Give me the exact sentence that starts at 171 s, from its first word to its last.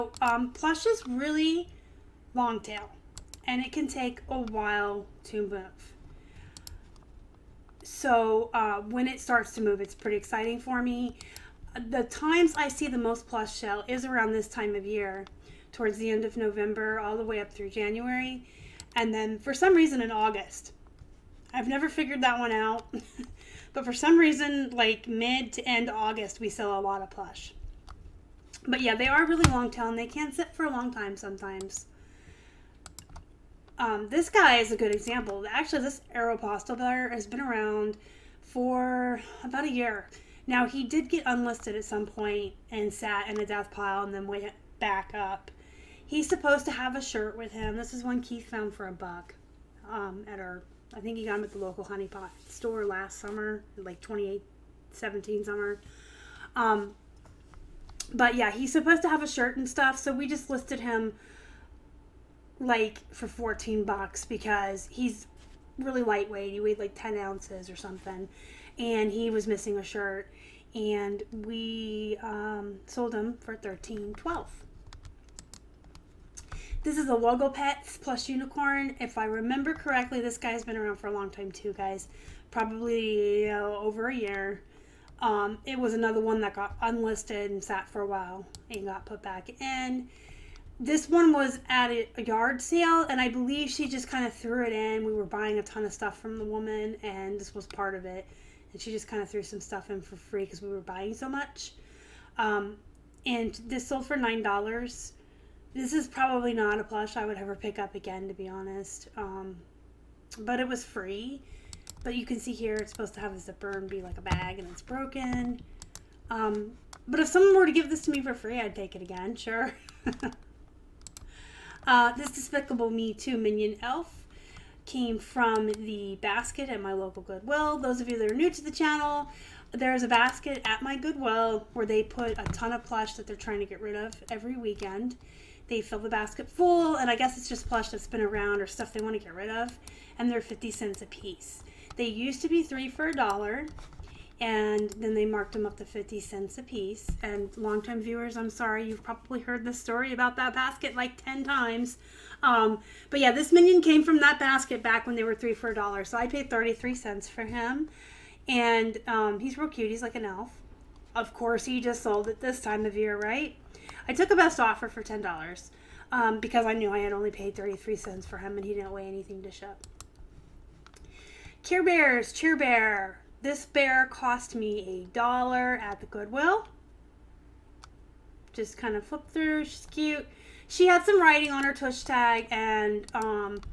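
Care Bears, Cheer Bear, this bear cost me a dollar at the Goodwill.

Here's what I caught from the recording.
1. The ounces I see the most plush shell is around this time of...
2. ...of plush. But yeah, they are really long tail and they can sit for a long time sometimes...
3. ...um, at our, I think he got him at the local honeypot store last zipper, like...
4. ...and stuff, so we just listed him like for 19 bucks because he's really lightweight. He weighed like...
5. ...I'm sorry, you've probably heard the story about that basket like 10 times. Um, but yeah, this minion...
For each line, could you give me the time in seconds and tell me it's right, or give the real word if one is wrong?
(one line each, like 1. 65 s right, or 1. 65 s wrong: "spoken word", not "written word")
1. 11 s wrong: "times", not "ounces"
2. 27 s right
3. 49 s wrong: "summer", not "zipper"
4. 59 s wrong: "14", not "19"
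5. 148 s right.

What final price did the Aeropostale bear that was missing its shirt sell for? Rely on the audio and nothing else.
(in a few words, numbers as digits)
$13.12.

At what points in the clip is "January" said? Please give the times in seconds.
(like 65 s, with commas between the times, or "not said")
17 s.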